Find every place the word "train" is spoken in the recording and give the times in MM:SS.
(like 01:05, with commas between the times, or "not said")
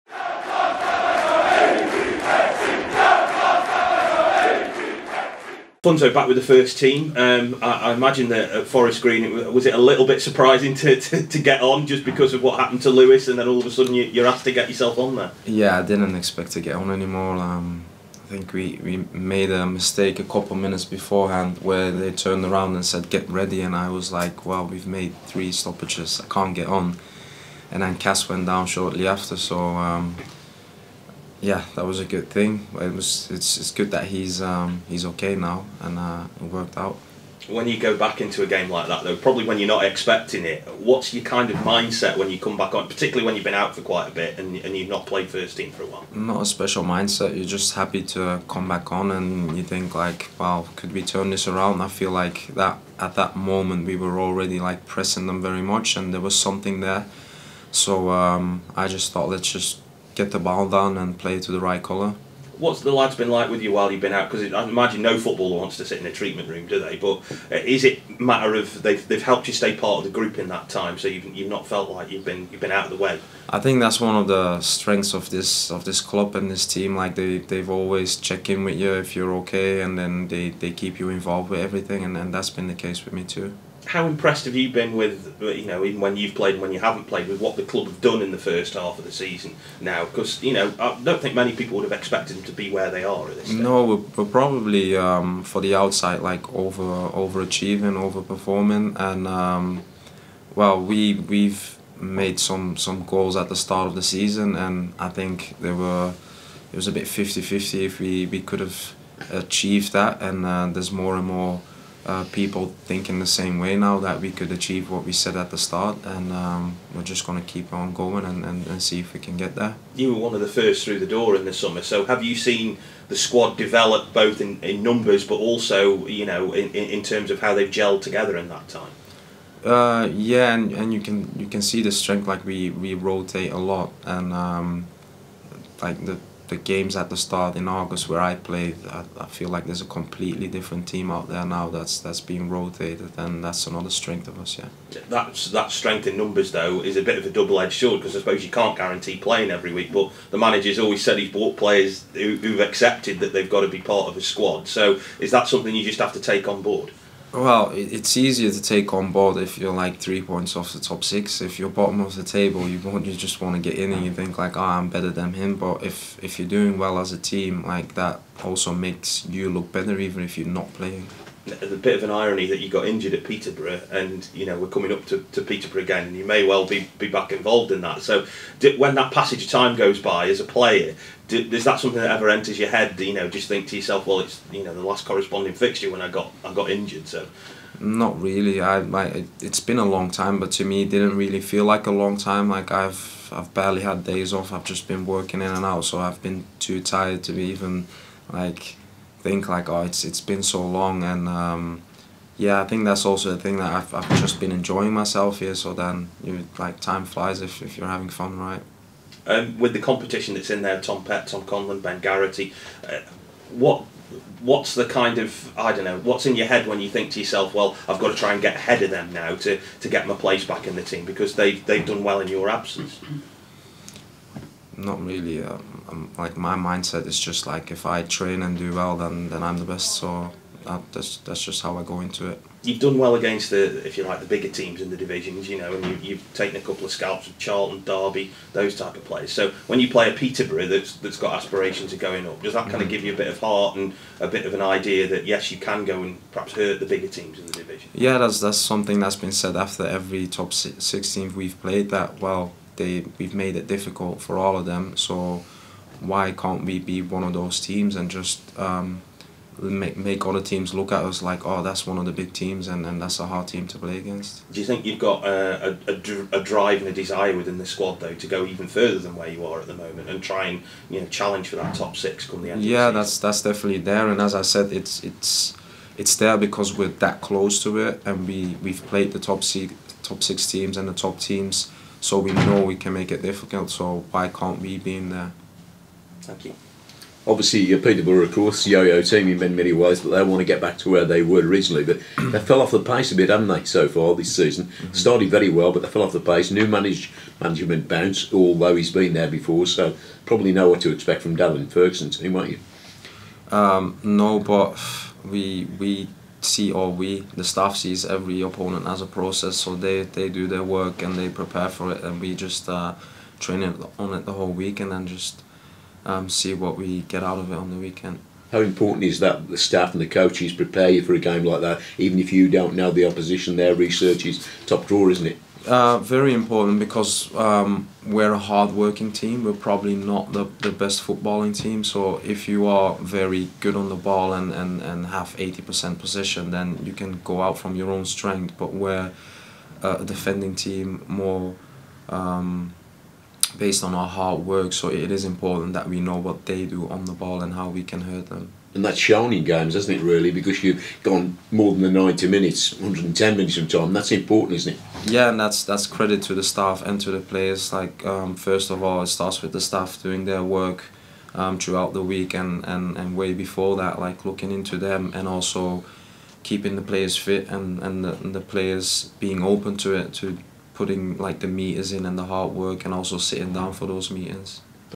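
03:48, 05:13.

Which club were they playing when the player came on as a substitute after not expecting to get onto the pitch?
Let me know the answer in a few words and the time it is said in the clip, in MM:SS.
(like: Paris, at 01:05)
Forest Green, at 00:08.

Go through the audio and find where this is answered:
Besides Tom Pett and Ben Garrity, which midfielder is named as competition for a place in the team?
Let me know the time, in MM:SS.
03:31.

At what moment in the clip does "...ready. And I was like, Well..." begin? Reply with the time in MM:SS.
00:23.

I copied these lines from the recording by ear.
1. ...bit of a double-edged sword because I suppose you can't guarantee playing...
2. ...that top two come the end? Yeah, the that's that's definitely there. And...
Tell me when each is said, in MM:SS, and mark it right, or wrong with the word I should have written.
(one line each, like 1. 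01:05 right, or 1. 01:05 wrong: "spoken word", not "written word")
1. 02:27 right
2. 04:31 wrong: "six", not "two".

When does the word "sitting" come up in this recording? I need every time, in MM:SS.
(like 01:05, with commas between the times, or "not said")
06:13.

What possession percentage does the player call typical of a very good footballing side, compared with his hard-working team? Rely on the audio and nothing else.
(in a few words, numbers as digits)
80%.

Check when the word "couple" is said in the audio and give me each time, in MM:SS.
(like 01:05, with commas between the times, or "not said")
00:20, 03:56.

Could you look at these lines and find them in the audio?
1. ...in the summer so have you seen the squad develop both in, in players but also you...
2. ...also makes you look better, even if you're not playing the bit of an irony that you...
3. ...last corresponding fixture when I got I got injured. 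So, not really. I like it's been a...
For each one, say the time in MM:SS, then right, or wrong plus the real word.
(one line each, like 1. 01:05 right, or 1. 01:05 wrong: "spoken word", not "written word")
1. 02:01 wrong: "numbers", not "players"
2. 02:48 right
3. 03:04 right.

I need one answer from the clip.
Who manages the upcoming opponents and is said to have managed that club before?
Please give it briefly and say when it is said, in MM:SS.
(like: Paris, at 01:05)
Darren Ferguson, at 05:01.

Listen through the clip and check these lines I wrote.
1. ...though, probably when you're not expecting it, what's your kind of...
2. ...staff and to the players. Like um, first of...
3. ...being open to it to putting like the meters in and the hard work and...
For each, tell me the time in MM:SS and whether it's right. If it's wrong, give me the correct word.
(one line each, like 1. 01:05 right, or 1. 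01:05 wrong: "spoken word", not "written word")
1. 00:39 right
2. 05:56 right
3. 06:09 right.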